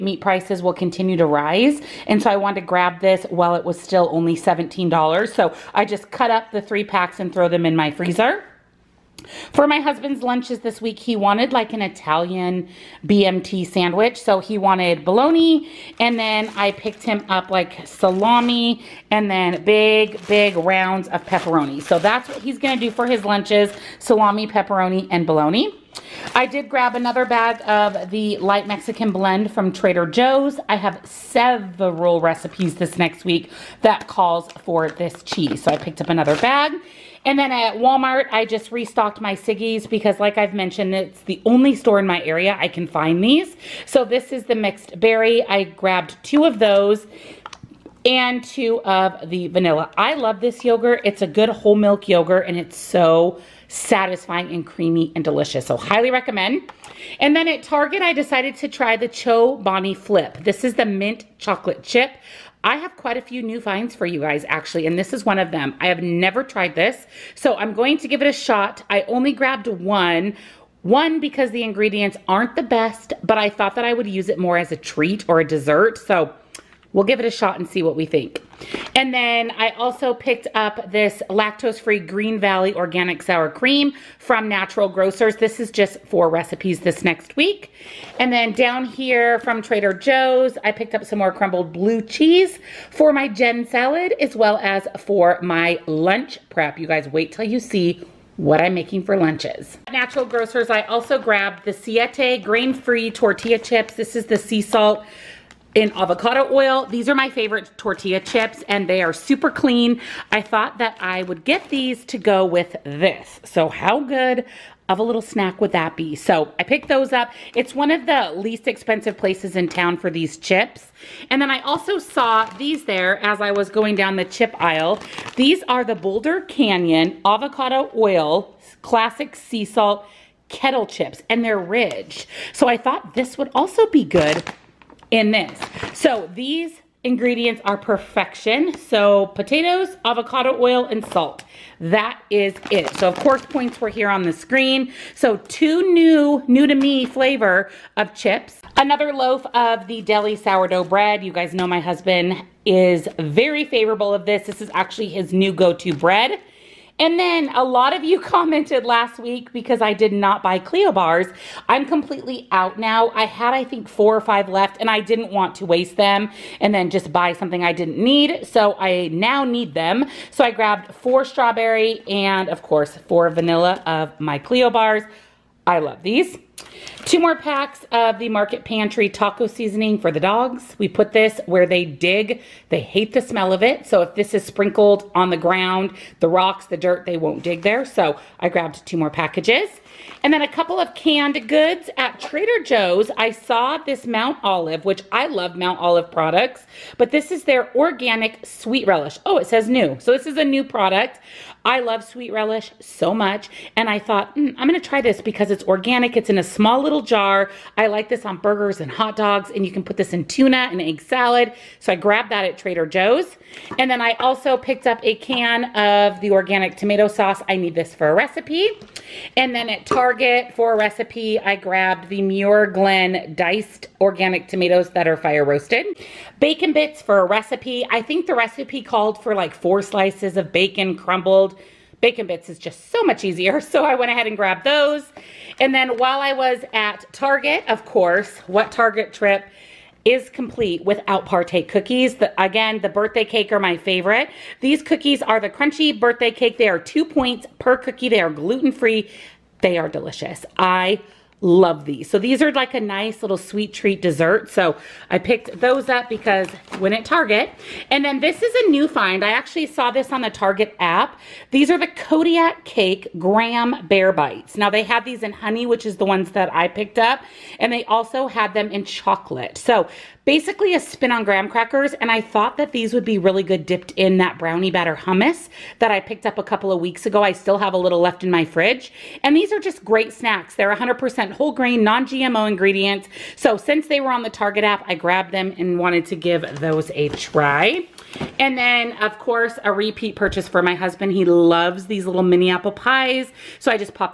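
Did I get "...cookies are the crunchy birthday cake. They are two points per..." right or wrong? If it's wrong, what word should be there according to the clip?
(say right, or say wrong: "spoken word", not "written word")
right.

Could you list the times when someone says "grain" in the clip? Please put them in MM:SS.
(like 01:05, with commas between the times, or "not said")
01:42, 04:41.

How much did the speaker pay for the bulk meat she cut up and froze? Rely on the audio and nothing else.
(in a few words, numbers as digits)
$17.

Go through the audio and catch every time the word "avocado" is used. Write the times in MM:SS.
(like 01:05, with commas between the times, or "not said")
01:45, 02:07, 02:20.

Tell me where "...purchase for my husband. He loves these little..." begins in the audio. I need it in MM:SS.
04:50.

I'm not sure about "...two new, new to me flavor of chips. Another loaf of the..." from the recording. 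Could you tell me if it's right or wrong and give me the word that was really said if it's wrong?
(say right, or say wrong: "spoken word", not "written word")
right.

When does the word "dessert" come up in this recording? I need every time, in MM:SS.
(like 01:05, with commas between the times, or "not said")
01:15, 04:14.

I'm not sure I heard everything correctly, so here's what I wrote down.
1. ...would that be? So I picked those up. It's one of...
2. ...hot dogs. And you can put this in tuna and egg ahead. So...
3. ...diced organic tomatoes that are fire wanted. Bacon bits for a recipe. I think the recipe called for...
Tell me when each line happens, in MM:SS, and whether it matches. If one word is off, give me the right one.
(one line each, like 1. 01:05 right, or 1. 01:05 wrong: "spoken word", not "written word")
1. 01:55 right
2. 03:28 wrong: "salad", not "ahead"
3. 03:43 wrong: "roasted", not "wanted".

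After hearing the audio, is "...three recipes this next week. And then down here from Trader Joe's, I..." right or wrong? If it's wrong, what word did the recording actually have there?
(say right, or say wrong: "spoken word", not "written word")
wrong: "four", not "three".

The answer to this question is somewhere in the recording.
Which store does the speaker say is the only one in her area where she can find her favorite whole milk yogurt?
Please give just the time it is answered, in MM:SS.
00:37.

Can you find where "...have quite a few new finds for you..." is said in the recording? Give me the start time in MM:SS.
01:02.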